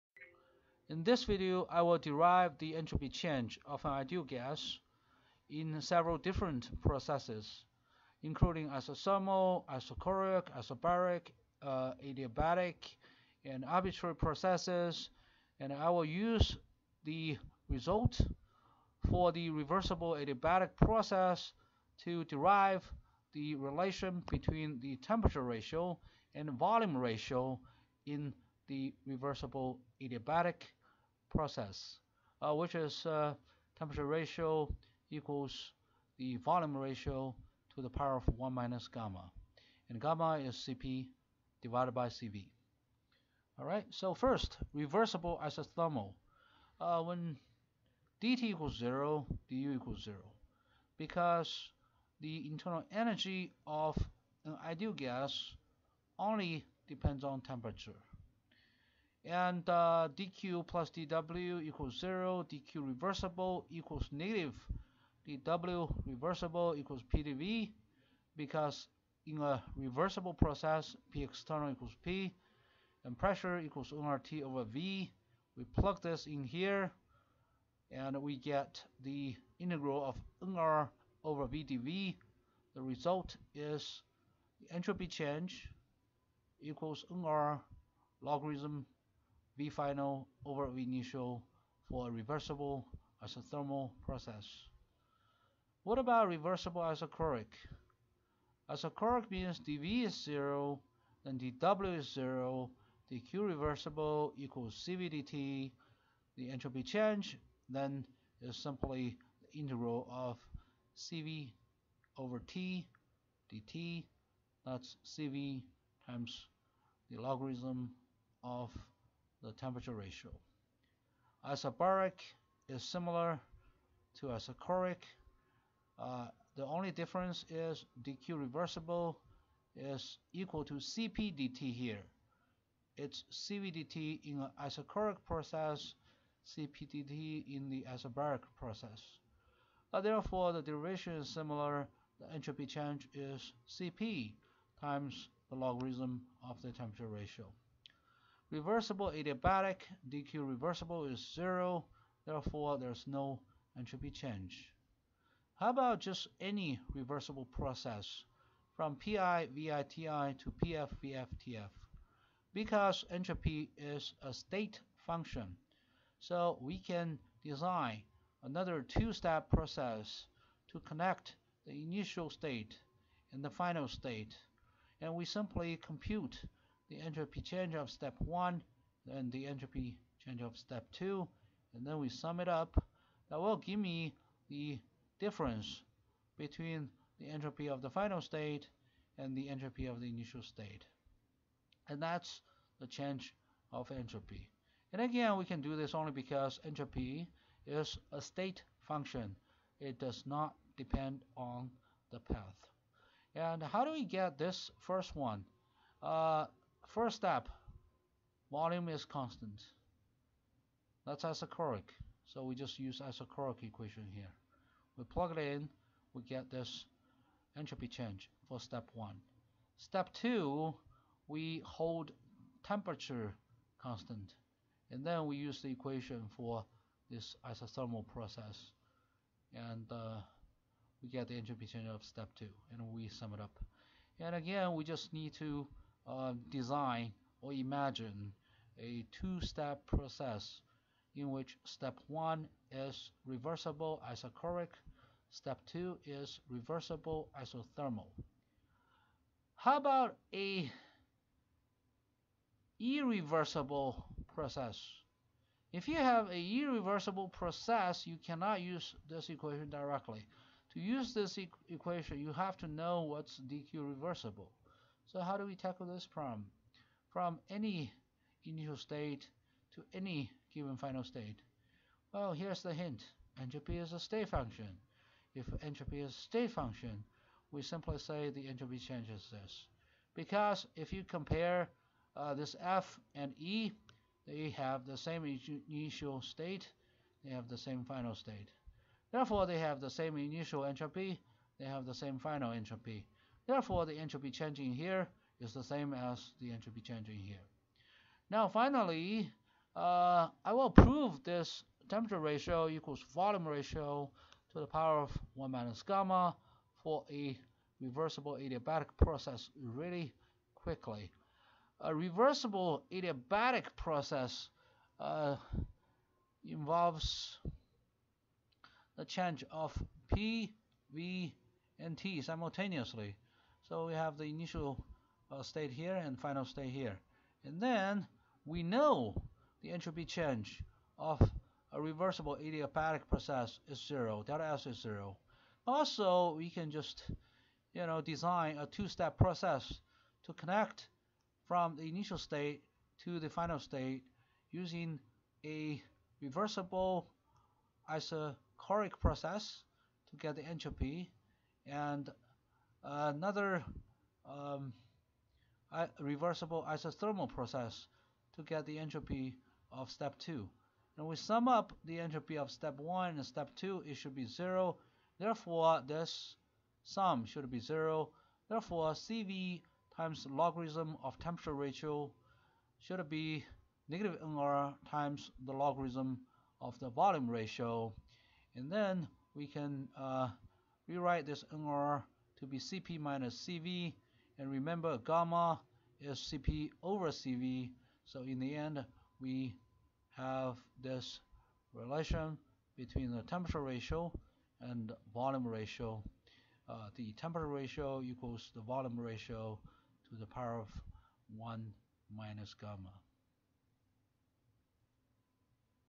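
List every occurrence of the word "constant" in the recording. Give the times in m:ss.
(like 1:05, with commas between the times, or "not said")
3:29, 3:43.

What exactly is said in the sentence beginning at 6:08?
Therefore, CV times logarithm of temperature ratio should be negative NR times the logarithm of the volume ratio.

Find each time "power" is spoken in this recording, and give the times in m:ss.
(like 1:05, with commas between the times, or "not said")
0:37, 5:04, 6:40.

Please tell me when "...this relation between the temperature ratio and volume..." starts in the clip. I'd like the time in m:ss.
6:30.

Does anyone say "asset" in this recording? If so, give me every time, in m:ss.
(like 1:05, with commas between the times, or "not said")
not said.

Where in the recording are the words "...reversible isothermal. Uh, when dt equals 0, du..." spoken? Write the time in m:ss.
0:44.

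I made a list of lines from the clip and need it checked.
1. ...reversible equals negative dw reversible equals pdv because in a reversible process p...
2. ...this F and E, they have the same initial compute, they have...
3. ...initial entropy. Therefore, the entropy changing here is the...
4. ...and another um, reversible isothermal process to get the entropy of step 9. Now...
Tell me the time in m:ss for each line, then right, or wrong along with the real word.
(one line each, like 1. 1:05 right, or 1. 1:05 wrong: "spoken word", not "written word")
1. 1:02 right
2. 4:42 wrong: "state", not "compute"
3. 4:52 wrong: "final", not "initial"
4. 5:51 wrong: "2", not "9".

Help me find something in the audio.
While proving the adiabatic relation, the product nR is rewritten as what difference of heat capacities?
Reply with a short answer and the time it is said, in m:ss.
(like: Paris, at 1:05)
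Cp minus Cv, at 6:22.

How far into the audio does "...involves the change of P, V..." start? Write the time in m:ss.
5:16.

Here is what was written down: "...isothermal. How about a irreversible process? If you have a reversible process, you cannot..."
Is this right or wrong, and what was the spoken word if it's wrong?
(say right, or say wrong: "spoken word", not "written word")
wrong: "irreversible", not "reversible".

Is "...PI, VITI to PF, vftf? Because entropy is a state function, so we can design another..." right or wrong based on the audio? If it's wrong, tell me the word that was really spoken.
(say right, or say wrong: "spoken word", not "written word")
right.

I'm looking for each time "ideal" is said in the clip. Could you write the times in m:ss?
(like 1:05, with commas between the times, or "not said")
0:03, 0:54.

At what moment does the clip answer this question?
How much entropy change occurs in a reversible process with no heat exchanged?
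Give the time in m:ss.
2:33.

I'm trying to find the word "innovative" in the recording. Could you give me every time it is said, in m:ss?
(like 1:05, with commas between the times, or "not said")
not said.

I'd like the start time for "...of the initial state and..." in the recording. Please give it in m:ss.
3:09.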